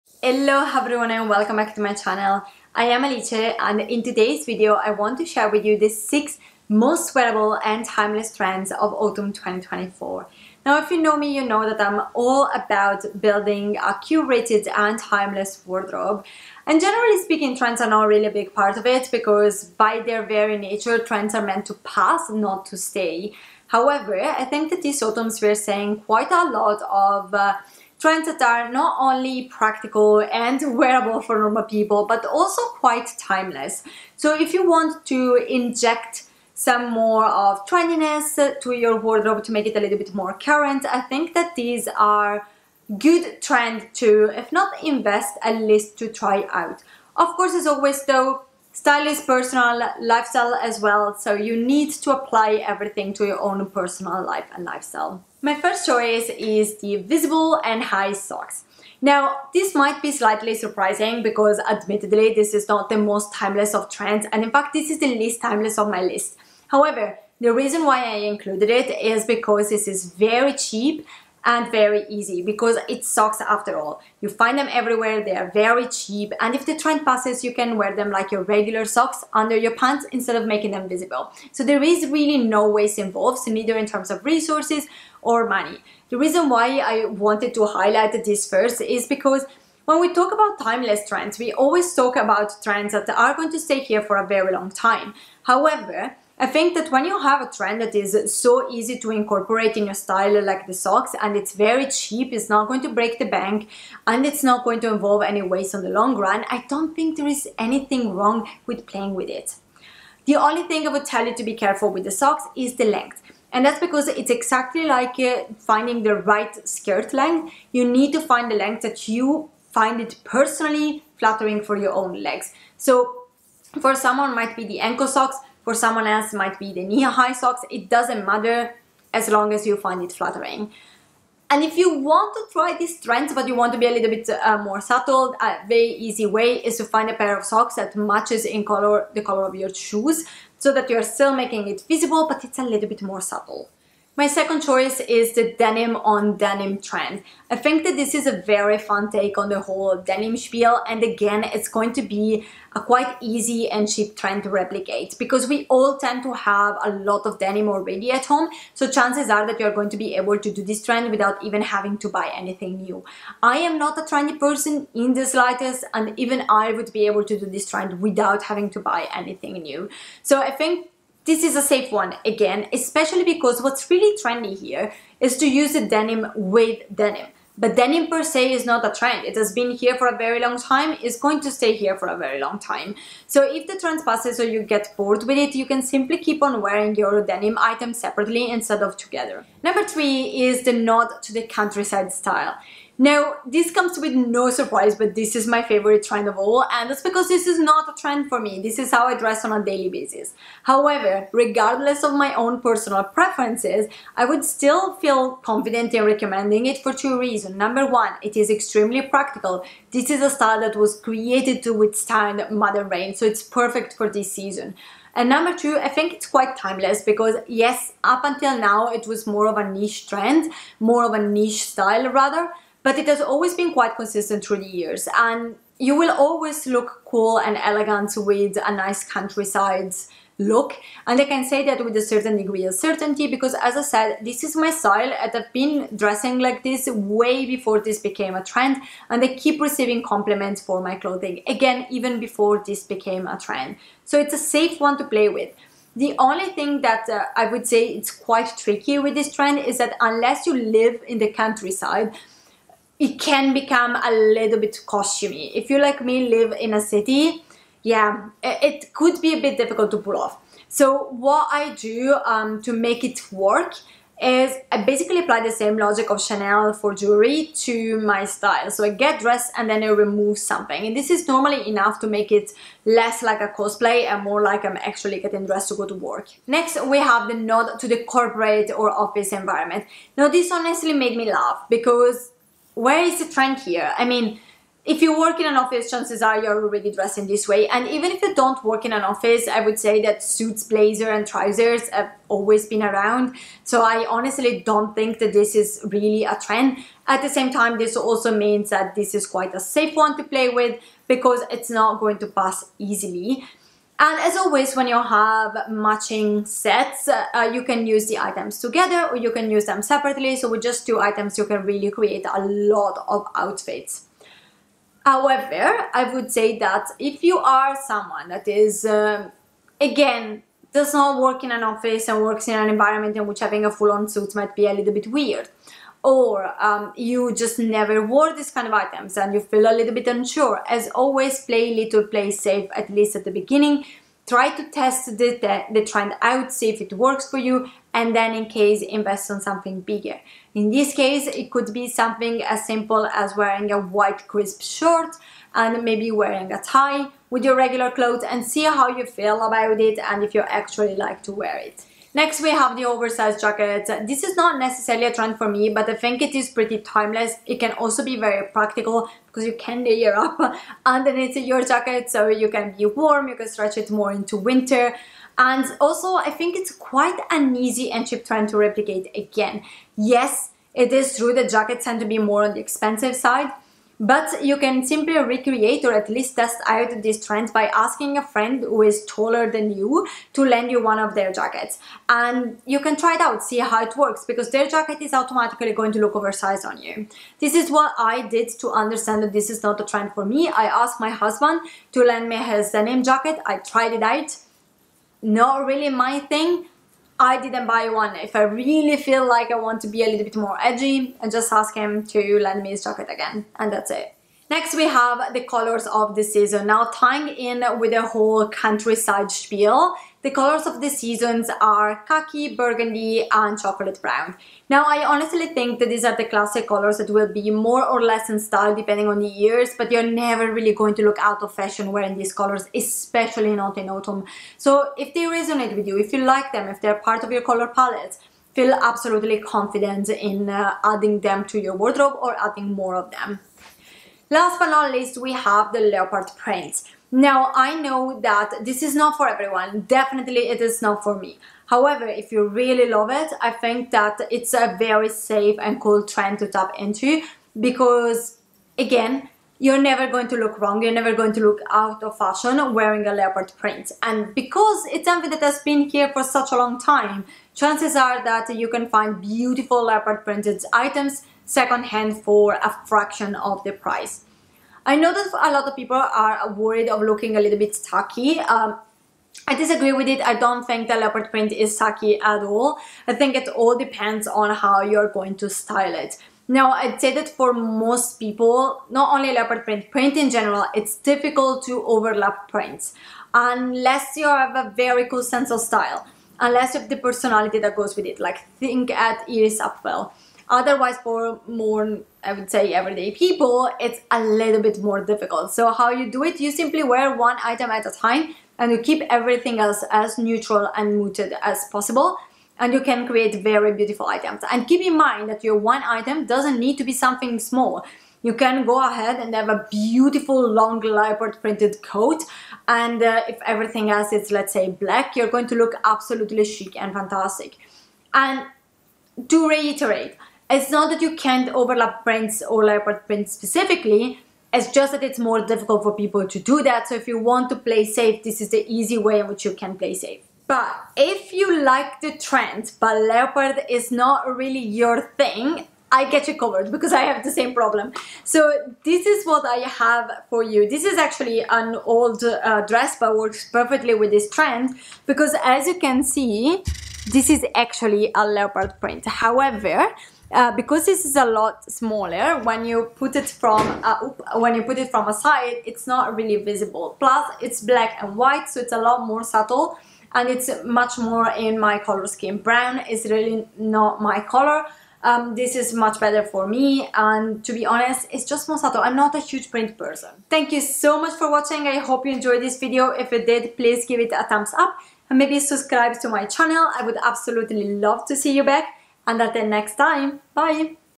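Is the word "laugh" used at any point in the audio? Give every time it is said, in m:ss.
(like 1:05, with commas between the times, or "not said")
4:41.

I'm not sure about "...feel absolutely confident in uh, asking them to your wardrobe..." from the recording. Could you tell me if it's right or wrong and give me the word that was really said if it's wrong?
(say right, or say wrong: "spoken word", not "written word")
wrong: "adding", not "asking".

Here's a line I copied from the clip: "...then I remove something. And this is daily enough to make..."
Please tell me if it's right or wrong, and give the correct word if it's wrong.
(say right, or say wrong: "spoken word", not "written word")
wrong: "normally", not "daily".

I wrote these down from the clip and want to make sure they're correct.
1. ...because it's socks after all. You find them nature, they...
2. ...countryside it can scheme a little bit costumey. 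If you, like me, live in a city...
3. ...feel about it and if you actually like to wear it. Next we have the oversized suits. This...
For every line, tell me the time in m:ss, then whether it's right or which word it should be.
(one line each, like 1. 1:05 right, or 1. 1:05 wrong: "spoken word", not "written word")
1. 1:12 wrong: "everywhere", not "nature"
2. 4:11 wrong: "become", not "scheme"
3. 5:49 wrong: "jackets", not "suits".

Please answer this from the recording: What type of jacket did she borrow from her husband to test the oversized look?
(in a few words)
Denim jacket.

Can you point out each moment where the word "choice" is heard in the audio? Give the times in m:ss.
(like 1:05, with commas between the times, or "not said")
0:55, 2:24.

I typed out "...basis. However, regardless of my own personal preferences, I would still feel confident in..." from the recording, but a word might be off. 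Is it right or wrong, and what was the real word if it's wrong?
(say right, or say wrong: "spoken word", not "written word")
right.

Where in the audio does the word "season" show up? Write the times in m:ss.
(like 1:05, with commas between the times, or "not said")
3:34, 6:46, 6:50.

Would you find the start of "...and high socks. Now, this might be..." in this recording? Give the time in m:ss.
0:57.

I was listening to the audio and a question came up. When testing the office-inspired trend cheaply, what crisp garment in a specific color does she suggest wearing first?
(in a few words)
White crisp shirt.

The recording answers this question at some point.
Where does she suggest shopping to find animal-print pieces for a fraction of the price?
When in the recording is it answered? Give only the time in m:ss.
7:41.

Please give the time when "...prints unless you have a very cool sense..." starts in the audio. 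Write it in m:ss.
8:02.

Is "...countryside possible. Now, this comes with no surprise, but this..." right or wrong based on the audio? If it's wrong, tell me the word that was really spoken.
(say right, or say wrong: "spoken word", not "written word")
wrong: "style", not "possible".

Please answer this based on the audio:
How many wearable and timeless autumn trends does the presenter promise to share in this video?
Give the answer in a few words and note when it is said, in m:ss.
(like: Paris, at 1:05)
6, at 0:05.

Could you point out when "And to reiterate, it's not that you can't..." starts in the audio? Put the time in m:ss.
8:38.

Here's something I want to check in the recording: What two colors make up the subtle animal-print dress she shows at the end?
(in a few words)
Black and white.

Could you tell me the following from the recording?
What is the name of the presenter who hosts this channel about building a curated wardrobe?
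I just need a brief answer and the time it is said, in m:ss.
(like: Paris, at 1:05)
Alice, at 0:03.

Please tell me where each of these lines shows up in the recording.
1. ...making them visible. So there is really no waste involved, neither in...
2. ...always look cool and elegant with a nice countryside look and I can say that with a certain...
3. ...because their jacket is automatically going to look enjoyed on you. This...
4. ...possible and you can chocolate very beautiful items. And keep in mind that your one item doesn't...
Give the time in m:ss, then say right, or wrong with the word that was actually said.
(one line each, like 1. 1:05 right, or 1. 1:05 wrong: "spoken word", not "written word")
1. 1:20 right
2. 3:46 right
3. 6:24 wrong: "oversized", not "enjoyed"
4. 8:21 wrong: "create", not "chocolate".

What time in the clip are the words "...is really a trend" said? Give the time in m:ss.
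4:55.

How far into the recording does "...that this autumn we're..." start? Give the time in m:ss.
0:24.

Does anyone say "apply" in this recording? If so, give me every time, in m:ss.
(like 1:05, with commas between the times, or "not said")
0:52, 4:25.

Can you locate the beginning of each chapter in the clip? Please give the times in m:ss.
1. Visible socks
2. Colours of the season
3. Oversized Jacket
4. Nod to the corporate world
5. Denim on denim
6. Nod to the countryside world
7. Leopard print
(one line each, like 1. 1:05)
1. 0:55
2. 6:44
3. 5:52
4. 4:36
5. 2:23
6. 3:09
7. 7:14.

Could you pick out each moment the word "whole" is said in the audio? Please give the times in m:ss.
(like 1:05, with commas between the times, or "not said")
2:29, 6:48.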